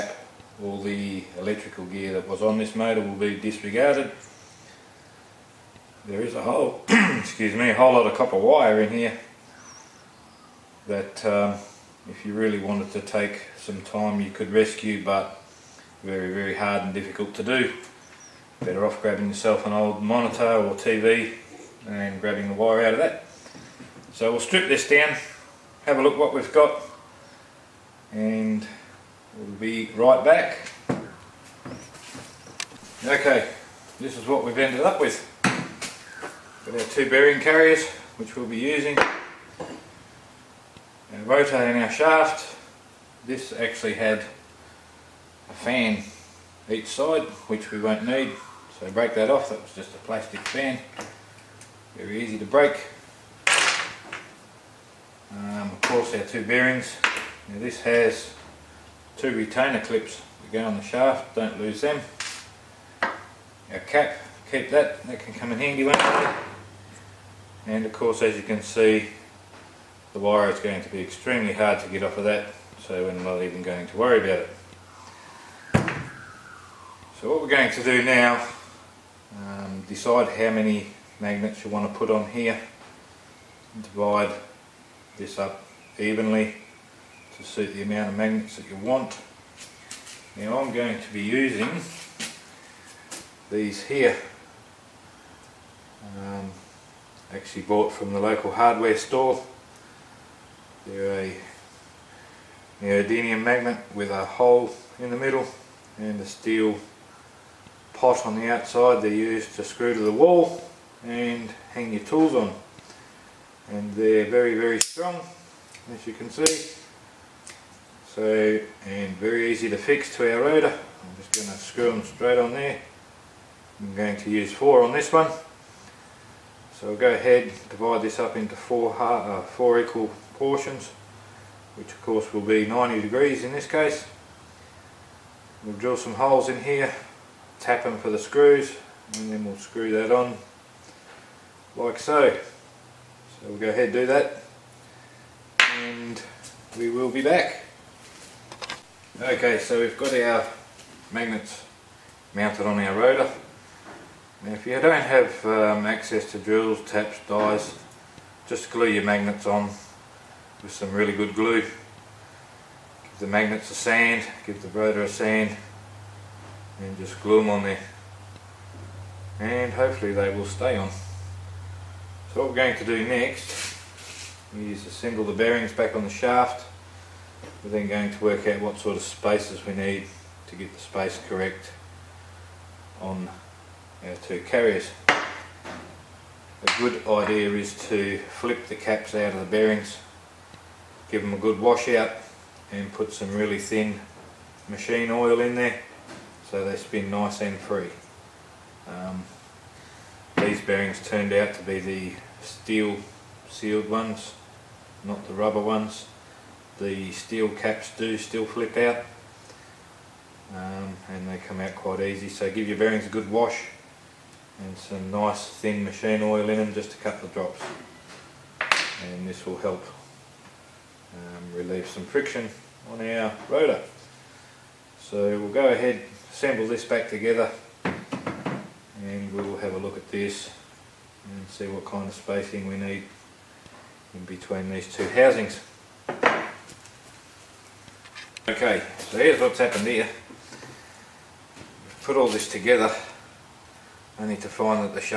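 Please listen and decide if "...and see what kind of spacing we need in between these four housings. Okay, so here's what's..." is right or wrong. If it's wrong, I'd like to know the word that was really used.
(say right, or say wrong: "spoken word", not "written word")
wrong: "two", not "four".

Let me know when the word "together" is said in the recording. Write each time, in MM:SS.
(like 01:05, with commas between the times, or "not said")
03:47, 04:02.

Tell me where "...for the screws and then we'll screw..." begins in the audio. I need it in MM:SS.
02:17.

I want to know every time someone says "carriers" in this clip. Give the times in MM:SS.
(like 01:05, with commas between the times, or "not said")
00:37, 03:04.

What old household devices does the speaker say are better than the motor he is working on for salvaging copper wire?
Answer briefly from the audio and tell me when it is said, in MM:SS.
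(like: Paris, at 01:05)
monitor or TV, at 00:20.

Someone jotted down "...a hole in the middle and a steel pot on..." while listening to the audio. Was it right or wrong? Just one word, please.
right.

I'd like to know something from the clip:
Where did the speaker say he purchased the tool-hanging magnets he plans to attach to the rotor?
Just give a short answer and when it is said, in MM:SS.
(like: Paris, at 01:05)
local hardware store, at 01:38.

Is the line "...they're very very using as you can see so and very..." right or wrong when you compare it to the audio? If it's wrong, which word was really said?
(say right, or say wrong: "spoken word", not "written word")
wrong: "strong", not "using".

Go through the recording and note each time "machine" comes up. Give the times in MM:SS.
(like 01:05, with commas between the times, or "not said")
03:14, 03:35.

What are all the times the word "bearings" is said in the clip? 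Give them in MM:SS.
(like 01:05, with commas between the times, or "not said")
00:37, 00:56, 02:55, 03:09, 03:20, 03:32.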